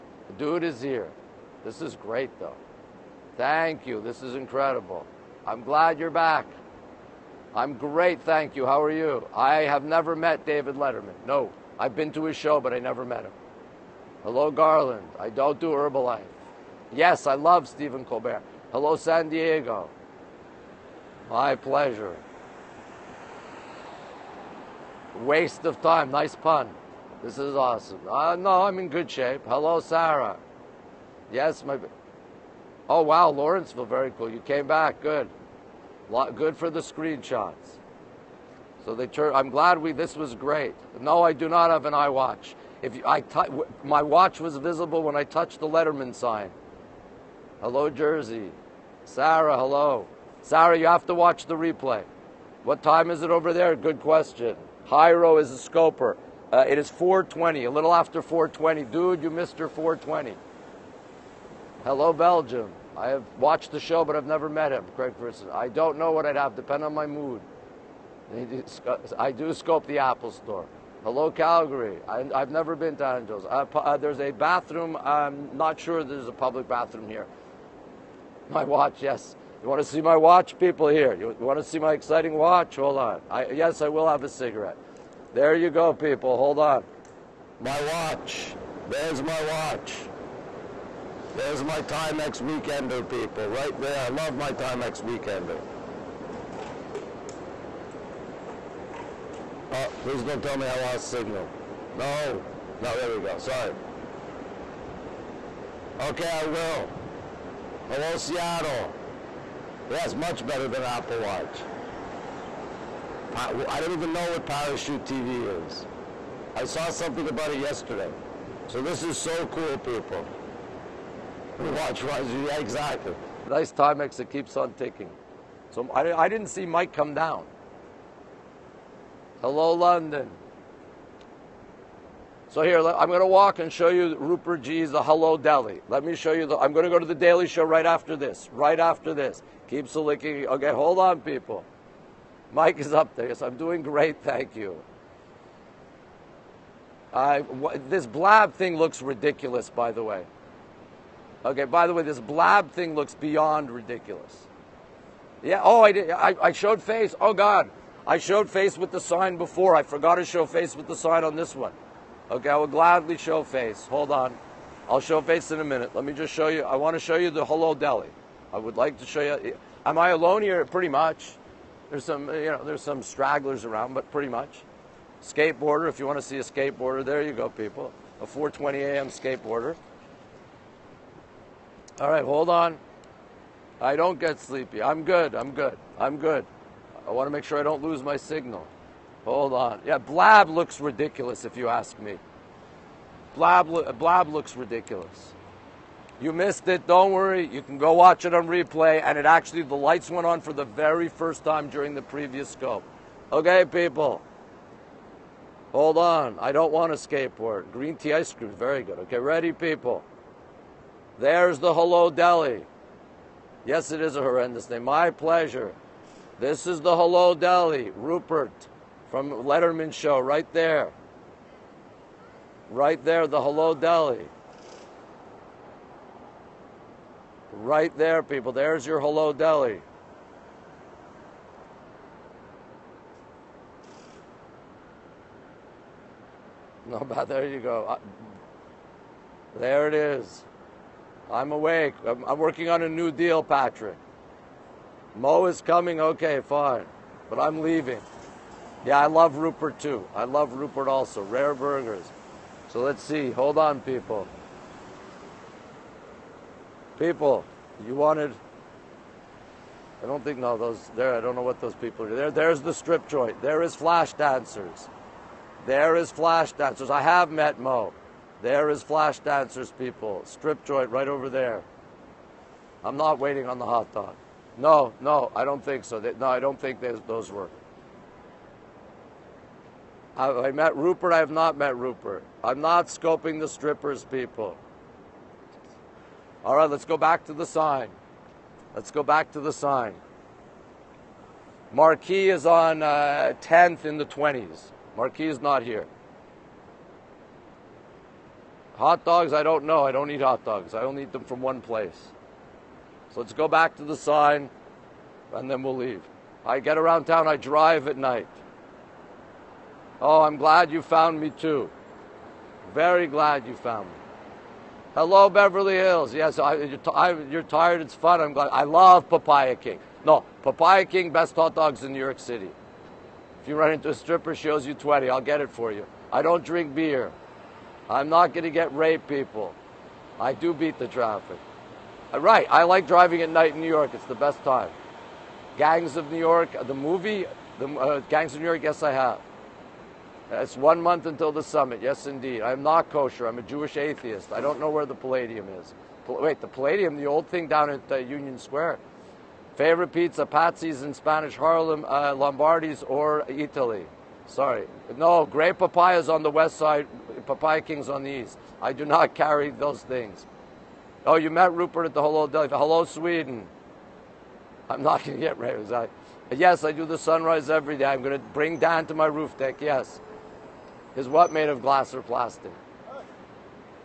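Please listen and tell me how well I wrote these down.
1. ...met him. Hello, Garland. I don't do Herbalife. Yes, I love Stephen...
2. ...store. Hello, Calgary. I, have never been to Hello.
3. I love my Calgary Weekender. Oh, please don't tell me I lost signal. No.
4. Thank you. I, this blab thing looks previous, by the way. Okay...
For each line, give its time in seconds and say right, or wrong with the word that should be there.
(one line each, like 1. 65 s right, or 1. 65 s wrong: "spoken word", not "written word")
1. 13 s right
2. 70 s wrong: "Angels", not "Hello"
3. 94 s wrong: "Timex", not "Calgary"
4. 144 s wrong: "ridiculous", not "previous".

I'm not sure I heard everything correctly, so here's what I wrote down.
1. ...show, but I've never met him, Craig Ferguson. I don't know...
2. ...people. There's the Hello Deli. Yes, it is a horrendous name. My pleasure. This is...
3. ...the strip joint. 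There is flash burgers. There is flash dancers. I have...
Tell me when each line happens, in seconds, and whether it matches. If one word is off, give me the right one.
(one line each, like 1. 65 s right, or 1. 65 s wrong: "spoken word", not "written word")
1. 63 s right
2. 209 s right
3. 262 s wrong: "dancers", not "burgers".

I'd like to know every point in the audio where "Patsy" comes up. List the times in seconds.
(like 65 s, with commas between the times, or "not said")
350 s.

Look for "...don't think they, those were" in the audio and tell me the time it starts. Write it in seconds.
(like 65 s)
276 s.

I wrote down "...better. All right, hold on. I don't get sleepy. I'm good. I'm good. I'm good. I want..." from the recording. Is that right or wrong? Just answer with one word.
wrong.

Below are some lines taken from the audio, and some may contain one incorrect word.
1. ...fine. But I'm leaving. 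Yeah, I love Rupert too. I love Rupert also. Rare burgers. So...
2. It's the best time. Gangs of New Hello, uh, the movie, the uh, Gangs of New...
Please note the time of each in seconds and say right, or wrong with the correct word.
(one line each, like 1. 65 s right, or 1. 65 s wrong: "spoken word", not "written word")
1. 246 s right
2. 333 s wrong: "York", not "Hello".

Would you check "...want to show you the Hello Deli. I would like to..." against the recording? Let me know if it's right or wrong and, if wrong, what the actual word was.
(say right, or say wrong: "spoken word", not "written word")
right.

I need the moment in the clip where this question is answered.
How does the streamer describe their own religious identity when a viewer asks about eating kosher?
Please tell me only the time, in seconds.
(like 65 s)
343 s.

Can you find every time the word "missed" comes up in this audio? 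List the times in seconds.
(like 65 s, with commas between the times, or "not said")
59 s, 196 s.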